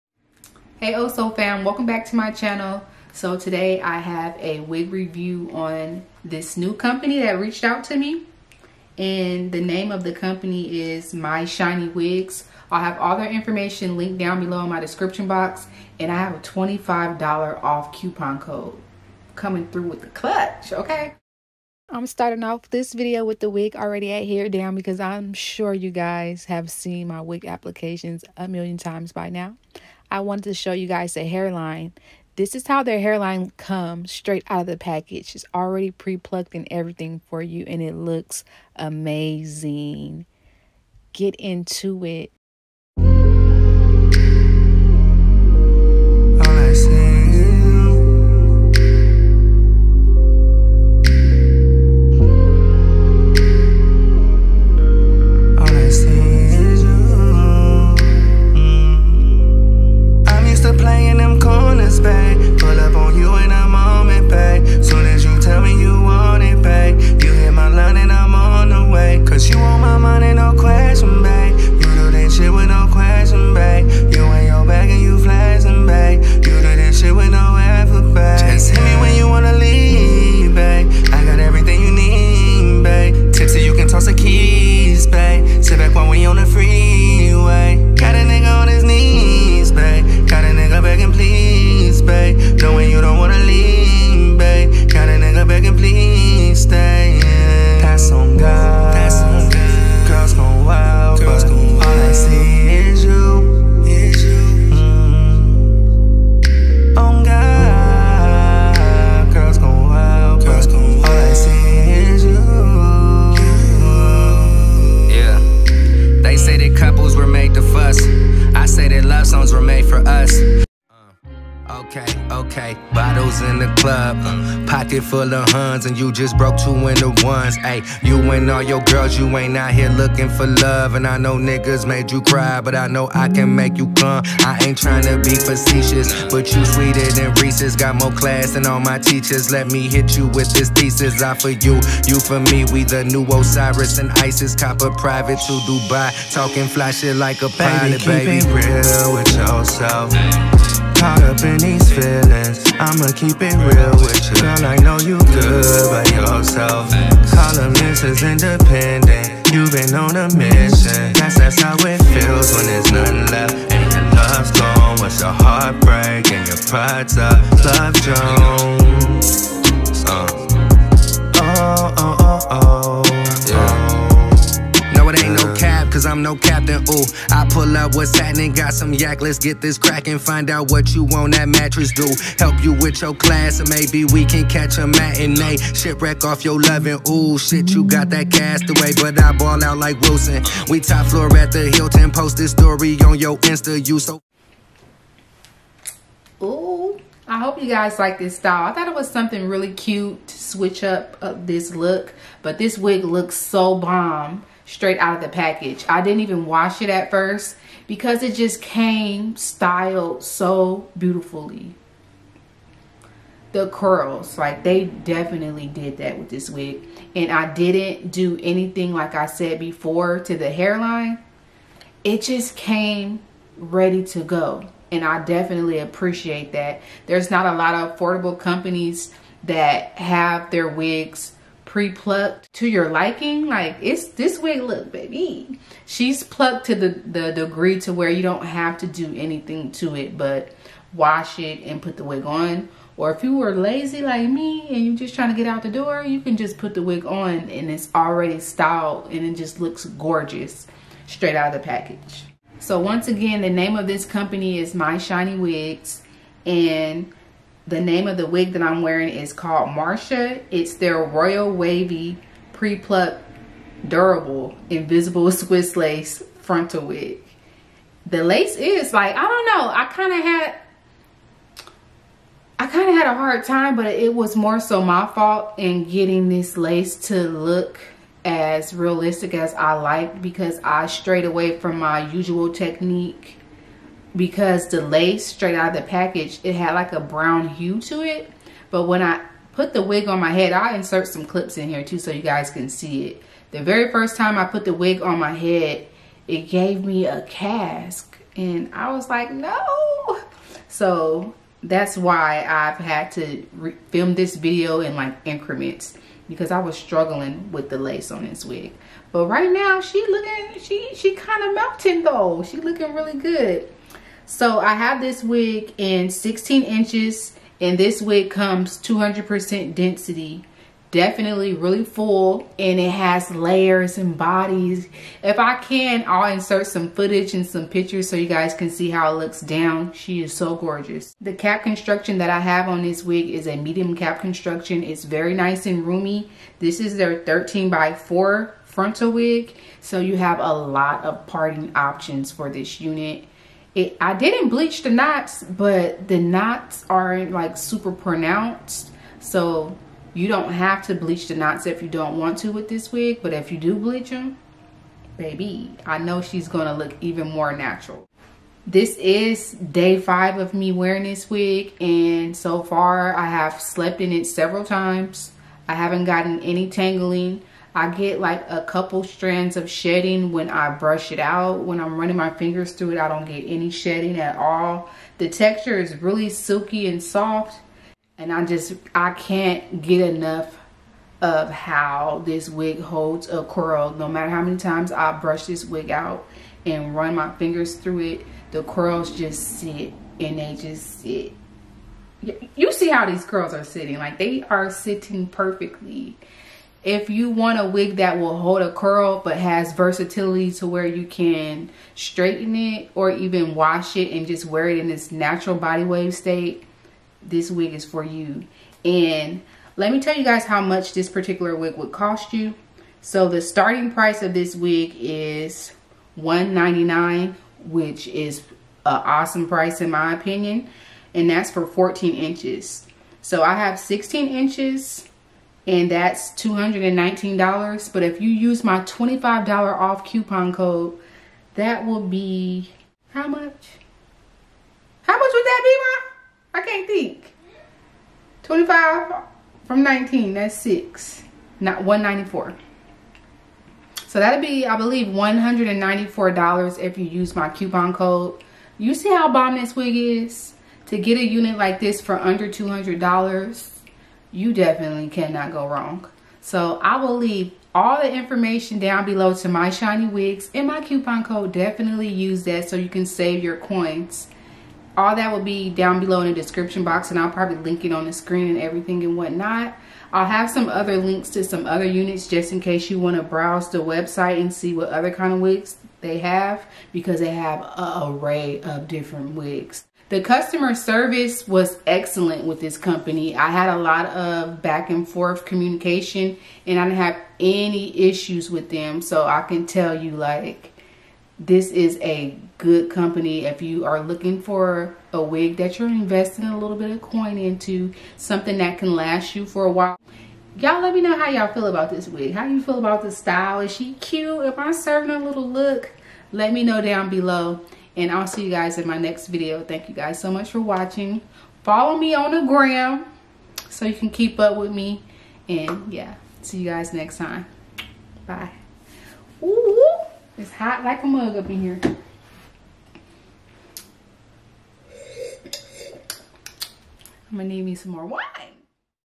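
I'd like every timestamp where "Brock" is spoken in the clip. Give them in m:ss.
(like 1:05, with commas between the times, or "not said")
not said.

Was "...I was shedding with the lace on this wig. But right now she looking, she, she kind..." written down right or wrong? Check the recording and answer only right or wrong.
wrong.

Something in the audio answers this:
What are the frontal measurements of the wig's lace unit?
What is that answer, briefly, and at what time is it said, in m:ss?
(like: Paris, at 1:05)
13 by 4, at 5:37.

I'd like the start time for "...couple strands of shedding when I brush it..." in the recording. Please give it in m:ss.
6:08.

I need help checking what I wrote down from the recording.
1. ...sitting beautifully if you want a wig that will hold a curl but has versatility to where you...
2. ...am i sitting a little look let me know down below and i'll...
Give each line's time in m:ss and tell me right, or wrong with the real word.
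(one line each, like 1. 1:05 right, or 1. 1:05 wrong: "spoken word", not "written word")
1. 6:34 wrong: "perfectly", not "beautifully"
2. 8:24 wrong: "serving", not "sitting".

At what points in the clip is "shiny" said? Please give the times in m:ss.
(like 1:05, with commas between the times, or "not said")
0:11, 4:14, 7:39.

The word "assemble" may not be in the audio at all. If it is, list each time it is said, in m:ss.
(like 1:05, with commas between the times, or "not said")
not said.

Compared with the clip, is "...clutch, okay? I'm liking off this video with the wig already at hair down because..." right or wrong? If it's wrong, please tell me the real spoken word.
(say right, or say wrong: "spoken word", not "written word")
wrong: "starting", not "liking".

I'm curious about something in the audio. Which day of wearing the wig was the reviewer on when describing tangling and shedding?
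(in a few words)
day 5.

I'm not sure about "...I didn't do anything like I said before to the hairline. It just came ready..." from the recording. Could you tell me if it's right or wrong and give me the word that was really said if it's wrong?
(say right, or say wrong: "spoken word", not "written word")
right.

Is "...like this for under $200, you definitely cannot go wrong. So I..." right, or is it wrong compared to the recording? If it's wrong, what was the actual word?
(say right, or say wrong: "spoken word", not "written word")
right.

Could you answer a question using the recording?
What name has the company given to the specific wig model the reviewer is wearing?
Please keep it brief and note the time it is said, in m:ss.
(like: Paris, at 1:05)
Marsha, at 4:19.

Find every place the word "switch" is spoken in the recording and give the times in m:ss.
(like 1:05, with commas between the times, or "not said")
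3:20.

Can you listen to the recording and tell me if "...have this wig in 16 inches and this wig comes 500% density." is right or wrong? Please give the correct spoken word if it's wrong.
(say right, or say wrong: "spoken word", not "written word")
wrong: "200", not "500".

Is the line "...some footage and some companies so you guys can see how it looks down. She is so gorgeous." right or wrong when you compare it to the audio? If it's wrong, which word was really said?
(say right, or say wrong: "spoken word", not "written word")
wrong: "pictures", not "companies".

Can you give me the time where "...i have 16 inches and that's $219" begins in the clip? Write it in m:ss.
7:03.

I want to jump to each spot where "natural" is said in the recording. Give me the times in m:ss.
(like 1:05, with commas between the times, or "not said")
5:57, 6:45.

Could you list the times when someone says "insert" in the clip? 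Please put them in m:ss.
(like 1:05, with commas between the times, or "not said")
4:50, 5:26.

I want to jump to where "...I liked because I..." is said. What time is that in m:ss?
4:39.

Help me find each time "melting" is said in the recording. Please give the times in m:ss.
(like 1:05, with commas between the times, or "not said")
5:11.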